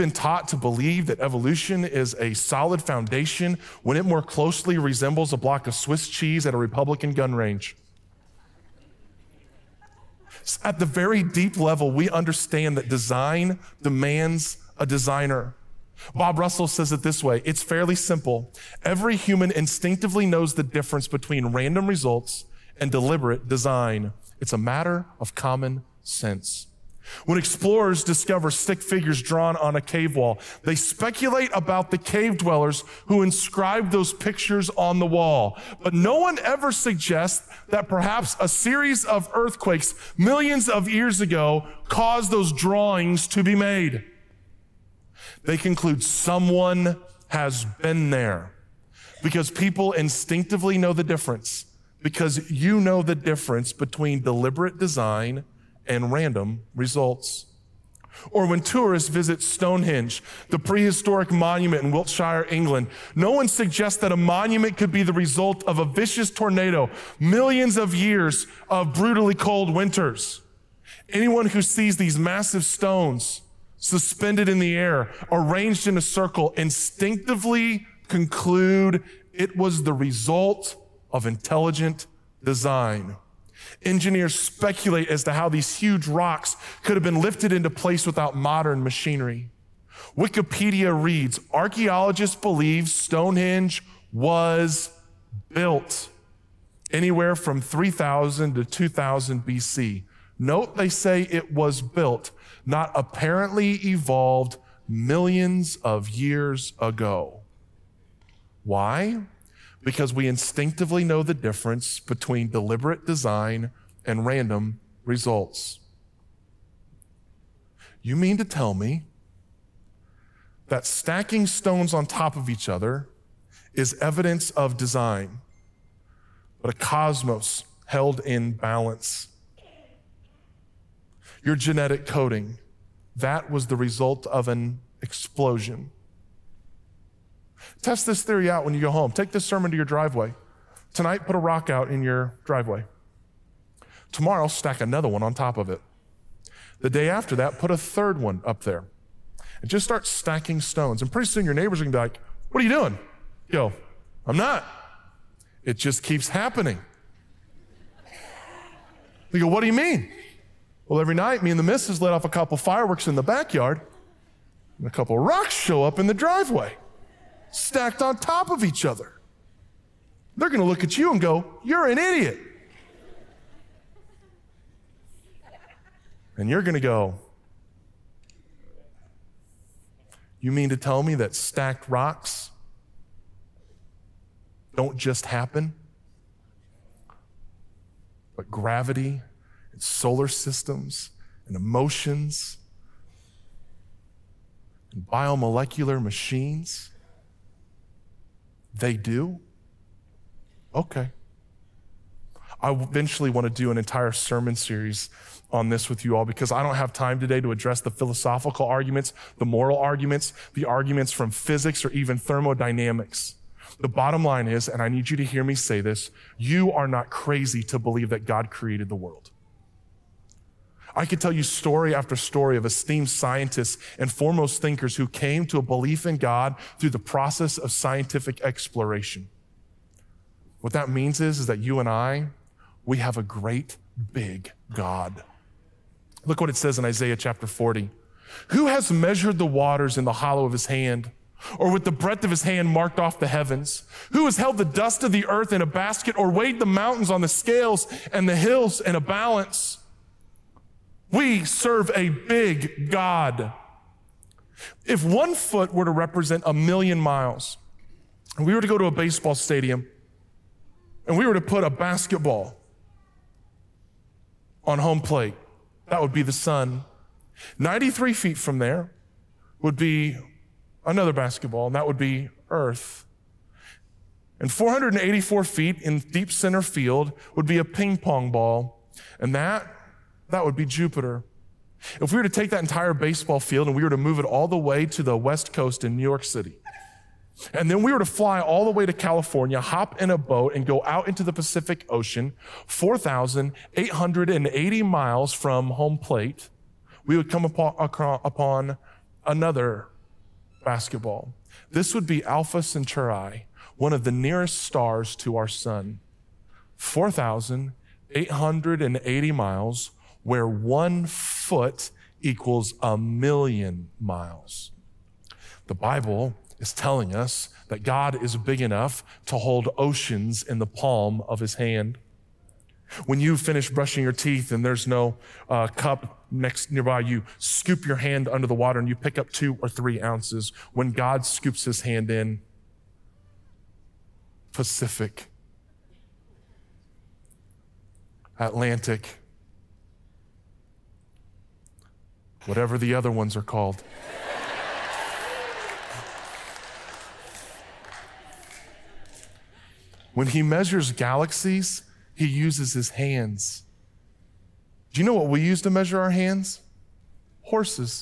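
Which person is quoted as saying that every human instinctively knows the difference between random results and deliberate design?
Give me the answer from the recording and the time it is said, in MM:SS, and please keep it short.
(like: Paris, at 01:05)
Bob Russell, at 00:16.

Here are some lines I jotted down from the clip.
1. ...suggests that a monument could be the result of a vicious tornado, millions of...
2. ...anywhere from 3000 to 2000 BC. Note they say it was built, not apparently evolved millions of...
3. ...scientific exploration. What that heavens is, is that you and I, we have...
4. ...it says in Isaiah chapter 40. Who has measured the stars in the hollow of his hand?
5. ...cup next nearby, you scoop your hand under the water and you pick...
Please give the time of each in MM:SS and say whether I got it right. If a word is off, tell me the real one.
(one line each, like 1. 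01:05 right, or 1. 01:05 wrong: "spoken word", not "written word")
1. 01:03 right
2. 01:36 right
3. 03:47 wrong: "means", not "heavens"
4. 03:56 wrong: "waters", not "stars"
5. 05:25 right.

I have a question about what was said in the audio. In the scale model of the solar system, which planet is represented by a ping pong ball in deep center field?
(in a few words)
Jupiter.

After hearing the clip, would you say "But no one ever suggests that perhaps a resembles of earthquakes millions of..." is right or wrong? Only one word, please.
wrong.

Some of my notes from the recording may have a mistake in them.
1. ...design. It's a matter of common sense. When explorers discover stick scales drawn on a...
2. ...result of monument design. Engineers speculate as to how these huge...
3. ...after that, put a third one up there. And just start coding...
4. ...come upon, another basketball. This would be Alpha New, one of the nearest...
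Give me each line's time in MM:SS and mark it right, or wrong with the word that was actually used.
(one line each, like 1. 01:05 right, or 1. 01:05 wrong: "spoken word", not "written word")
1. 00:23 wrong: "figures", not "scales"
2. 01:19 wrong: "intelligent", not "monument"
3. 02:27 wrong: "stacking", not "coding"
4. 04:57 wrong: "Centauri", not "New".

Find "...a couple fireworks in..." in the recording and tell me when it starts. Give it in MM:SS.
02:42.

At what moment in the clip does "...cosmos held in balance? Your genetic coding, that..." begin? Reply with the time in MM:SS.
02:06.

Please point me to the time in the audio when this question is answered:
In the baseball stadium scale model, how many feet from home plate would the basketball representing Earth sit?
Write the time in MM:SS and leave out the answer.
04:27.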